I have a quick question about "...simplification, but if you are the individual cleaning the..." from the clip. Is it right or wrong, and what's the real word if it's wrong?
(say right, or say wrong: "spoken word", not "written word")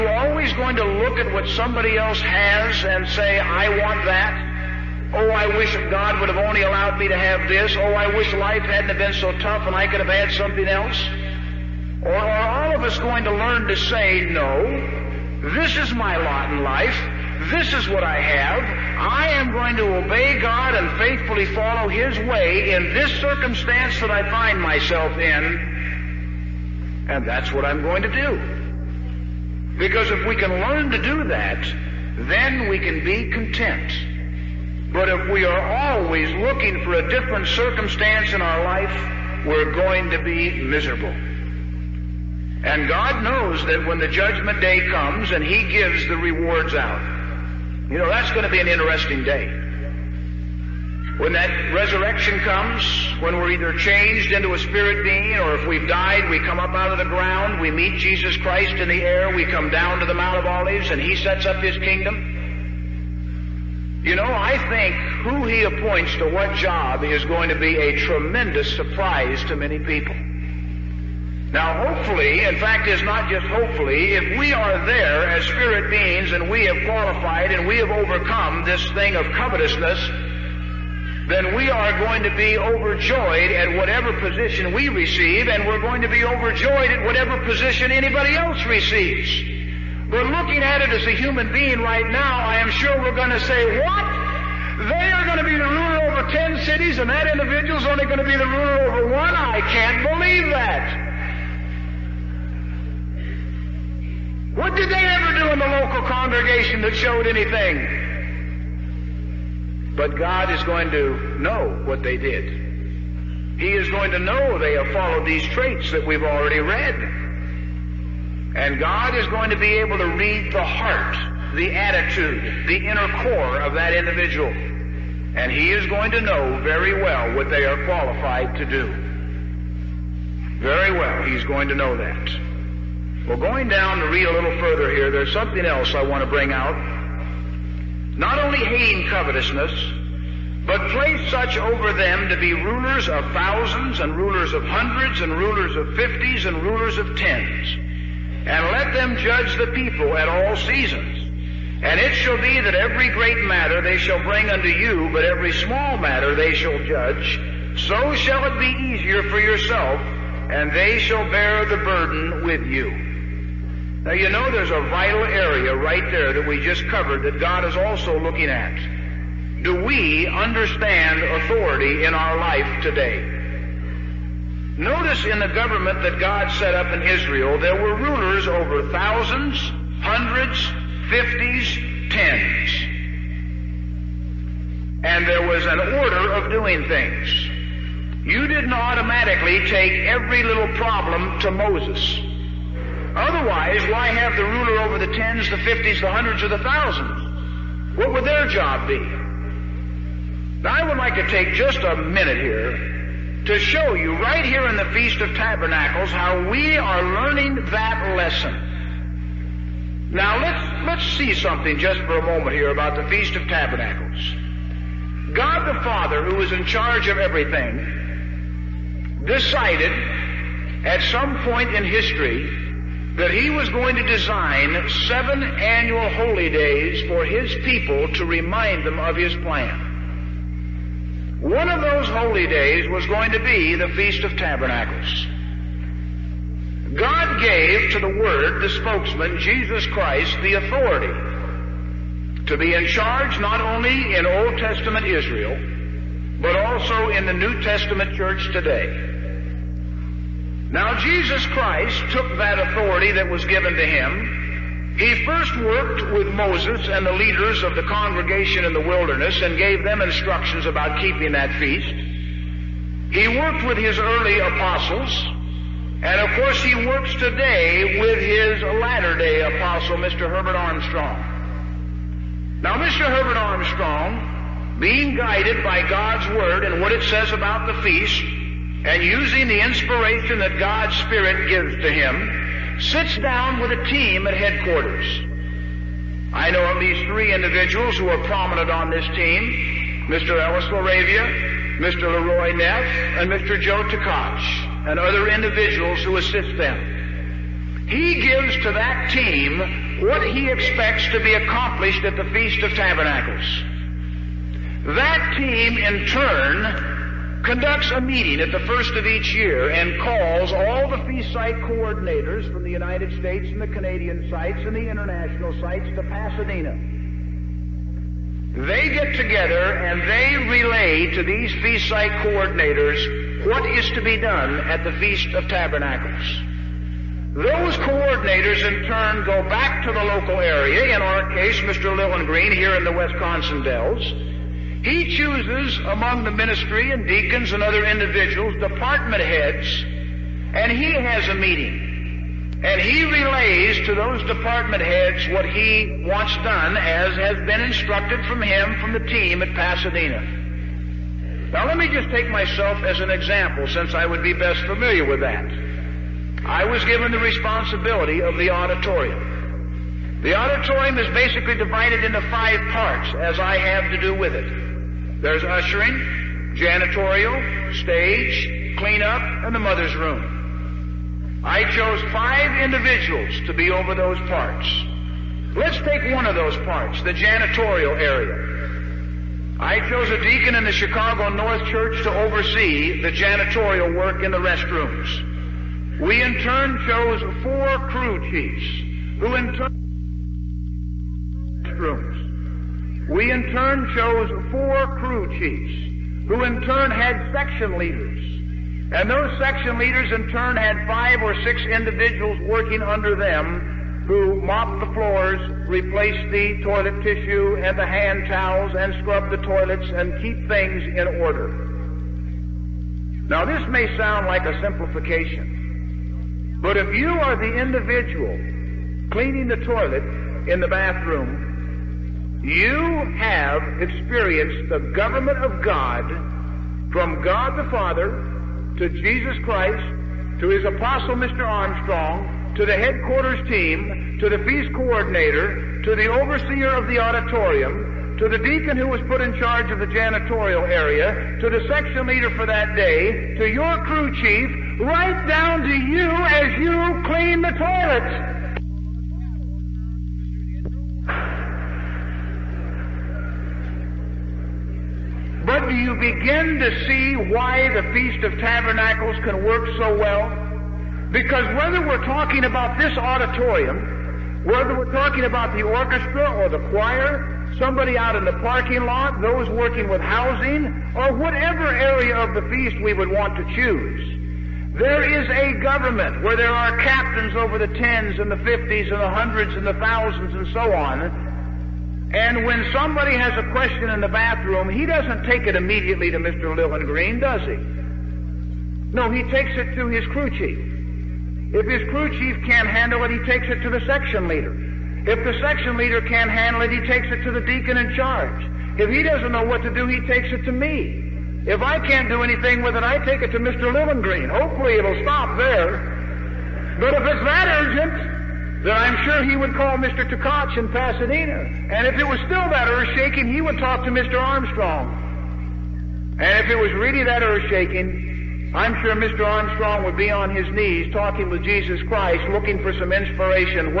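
right.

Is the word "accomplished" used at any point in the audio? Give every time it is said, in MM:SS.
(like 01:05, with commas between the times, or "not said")
05:01.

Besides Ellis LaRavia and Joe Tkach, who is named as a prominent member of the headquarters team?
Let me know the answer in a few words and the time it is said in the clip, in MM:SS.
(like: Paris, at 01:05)
Leroy Neff, at 04:51.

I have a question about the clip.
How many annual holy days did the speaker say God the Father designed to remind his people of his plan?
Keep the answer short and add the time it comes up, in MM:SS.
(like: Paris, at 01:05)
7, at 03:45.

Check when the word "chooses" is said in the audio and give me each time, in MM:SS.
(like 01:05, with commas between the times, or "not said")
05:35, 07:53.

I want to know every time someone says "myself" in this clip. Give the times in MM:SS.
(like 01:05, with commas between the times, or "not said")
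00:24, 05:52.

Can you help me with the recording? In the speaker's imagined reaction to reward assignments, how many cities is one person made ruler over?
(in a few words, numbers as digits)
10.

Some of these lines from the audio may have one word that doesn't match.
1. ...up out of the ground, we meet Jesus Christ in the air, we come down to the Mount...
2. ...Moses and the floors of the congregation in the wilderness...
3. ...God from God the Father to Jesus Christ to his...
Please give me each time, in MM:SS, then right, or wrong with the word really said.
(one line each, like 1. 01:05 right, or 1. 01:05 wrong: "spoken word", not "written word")
1. 00:56 right
2. 04:16 wrong: "leaders", not "floors"
3. 07:05 right.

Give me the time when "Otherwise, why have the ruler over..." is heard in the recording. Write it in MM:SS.
03:13.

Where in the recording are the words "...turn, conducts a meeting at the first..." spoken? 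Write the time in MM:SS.
05:06.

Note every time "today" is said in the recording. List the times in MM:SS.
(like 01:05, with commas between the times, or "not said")
02:52, 04:08, 04:27.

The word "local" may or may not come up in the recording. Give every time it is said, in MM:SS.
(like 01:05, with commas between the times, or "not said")
01:45, 05:30.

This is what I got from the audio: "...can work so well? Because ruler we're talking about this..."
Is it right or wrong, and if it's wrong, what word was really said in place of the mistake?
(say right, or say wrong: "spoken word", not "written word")
wrong: "whether", not "ruler".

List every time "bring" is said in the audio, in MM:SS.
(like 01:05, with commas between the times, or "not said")
02:16, 02:34.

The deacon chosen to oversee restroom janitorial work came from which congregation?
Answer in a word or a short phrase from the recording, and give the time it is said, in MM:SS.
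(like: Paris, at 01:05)
Chicago North Church, at 06:20.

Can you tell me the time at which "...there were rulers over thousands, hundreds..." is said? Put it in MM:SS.
02:57.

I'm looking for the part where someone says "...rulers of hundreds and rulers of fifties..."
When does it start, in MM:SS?
02:24.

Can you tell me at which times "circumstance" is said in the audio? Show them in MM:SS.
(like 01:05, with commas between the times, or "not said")
00:23, 00:37.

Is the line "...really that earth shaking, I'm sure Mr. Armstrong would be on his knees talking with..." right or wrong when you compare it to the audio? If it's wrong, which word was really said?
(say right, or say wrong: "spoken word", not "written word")
right.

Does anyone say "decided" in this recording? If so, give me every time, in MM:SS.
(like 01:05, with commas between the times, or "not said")
03:39.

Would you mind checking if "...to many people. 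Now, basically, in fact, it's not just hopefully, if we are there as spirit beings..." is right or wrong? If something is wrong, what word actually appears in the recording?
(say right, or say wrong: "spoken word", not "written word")
wrong: "hopefully", not "basically".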